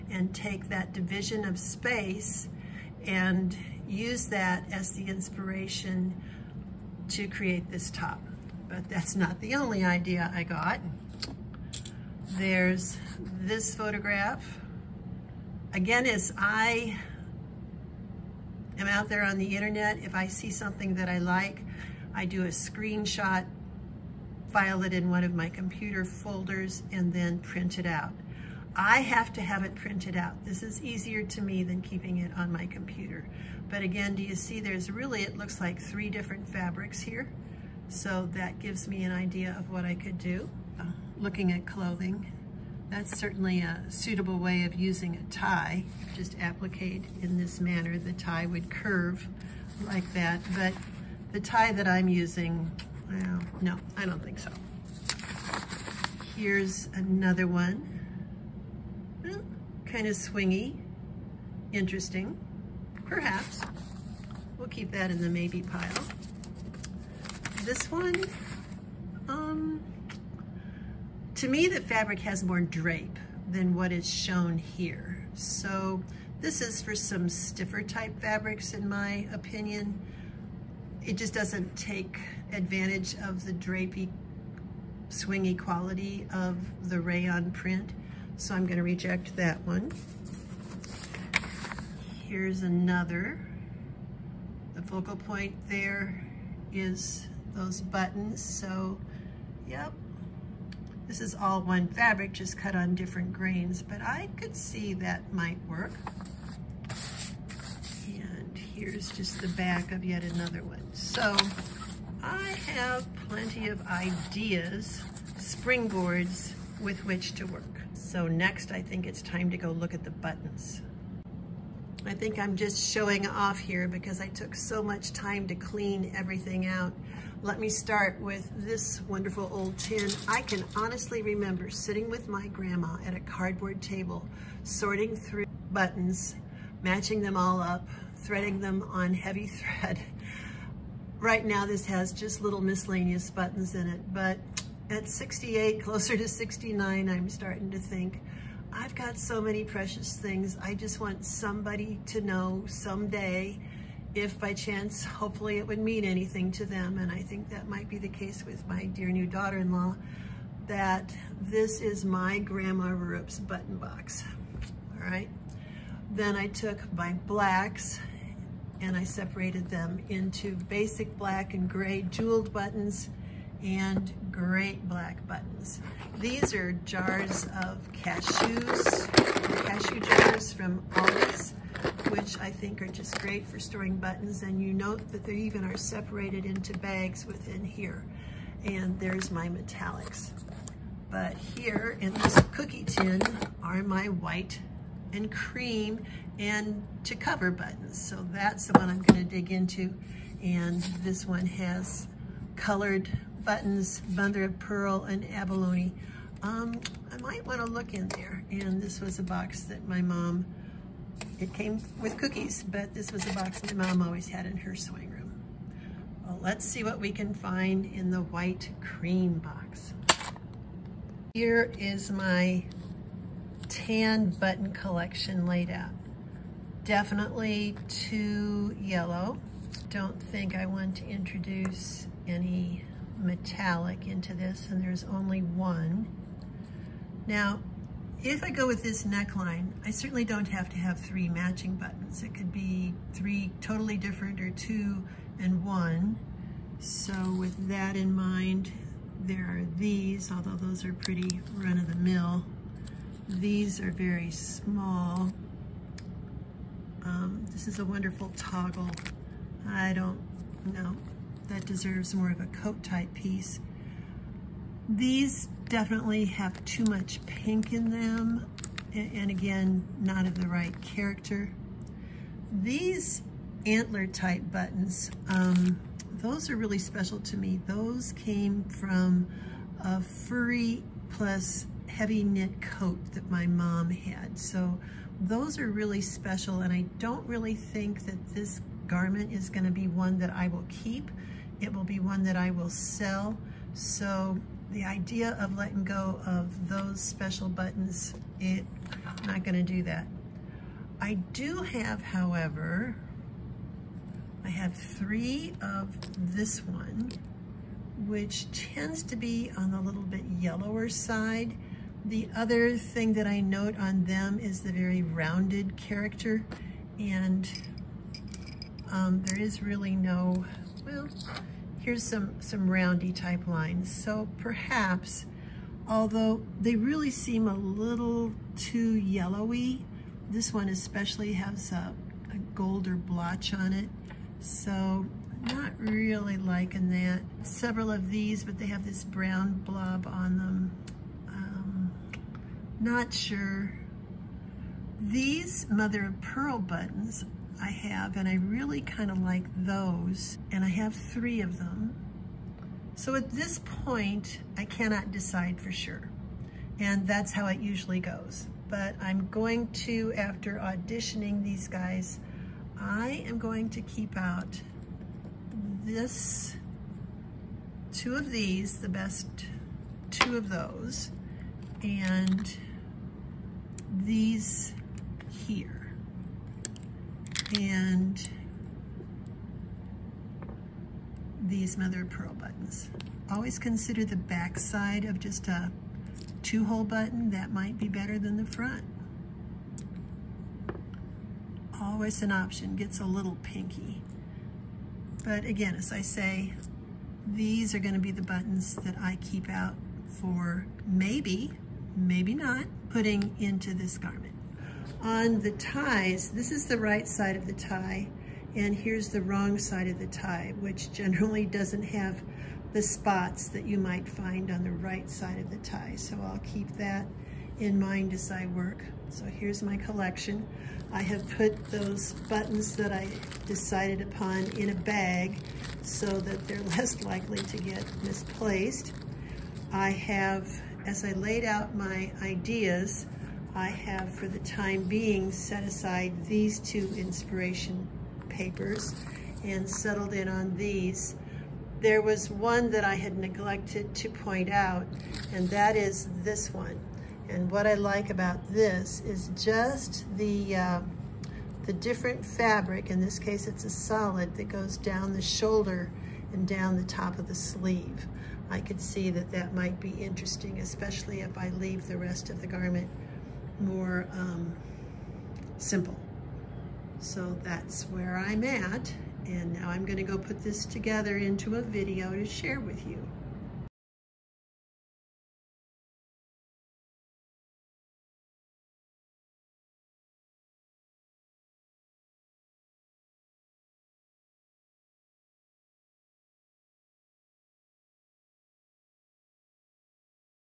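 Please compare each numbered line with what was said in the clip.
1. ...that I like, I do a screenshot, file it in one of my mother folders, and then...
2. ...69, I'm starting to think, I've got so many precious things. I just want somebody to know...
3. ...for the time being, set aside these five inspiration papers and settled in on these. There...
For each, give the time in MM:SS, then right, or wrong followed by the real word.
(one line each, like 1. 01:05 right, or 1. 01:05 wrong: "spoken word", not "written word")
1. 00:20 wrong: "computer", not "mother"
2. 02:26 right
3. 07:14 wrong: "two", not "five".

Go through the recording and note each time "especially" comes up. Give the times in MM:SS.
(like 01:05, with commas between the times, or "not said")
05:30, 07:40.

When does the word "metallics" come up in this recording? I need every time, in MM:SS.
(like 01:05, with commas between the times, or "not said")
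03:09, 03:53.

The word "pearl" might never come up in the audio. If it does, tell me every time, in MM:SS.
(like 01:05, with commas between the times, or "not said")
03:24, 05:46, 06:22.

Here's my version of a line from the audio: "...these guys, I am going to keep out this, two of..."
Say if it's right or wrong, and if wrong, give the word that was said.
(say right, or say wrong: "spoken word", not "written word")
right.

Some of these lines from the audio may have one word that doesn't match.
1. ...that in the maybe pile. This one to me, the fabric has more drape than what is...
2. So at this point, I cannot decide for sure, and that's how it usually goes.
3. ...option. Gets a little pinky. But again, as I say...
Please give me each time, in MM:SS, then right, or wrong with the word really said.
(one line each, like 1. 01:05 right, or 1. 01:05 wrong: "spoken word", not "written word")
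1. 01:04 right
2. 05:52 right
3. 06:32 right.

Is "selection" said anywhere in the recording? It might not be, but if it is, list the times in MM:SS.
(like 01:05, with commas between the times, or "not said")
not said.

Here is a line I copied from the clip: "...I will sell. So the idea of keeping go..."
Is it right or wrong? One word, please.
wrong.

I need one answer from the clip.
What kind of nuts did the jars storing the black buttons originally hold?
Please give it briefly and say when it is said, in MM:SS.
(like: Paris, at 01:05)
cashews, at 02:57.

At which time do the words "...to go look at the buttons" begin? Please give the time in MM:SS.
01:59.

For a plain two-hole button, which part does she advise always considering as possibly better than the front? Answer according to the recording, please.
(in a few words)
back side.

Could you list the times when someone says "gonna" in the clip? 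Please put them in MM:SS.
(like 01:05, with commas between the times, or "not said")
01:28, 03:19, 04:49, 04:59, 07:49.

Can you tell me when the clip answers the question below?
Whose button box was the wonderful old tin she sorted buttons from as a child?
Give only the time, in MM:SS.
02:42.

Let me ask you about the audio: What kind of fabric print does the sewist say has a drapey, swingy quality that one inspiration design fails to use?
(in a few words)
rayon.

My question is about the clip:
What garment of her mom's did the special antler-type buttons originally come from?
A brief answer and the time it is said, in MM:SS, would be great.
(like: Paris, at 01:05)
heavy knit coat, at 04:41.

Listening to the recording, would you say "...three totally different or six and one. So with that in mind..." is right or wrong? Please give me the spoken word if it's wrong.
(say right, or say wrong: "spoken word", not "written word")
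wrong: "two", not "six".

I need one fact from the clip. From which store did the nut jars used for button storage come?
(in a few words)
Aldi's.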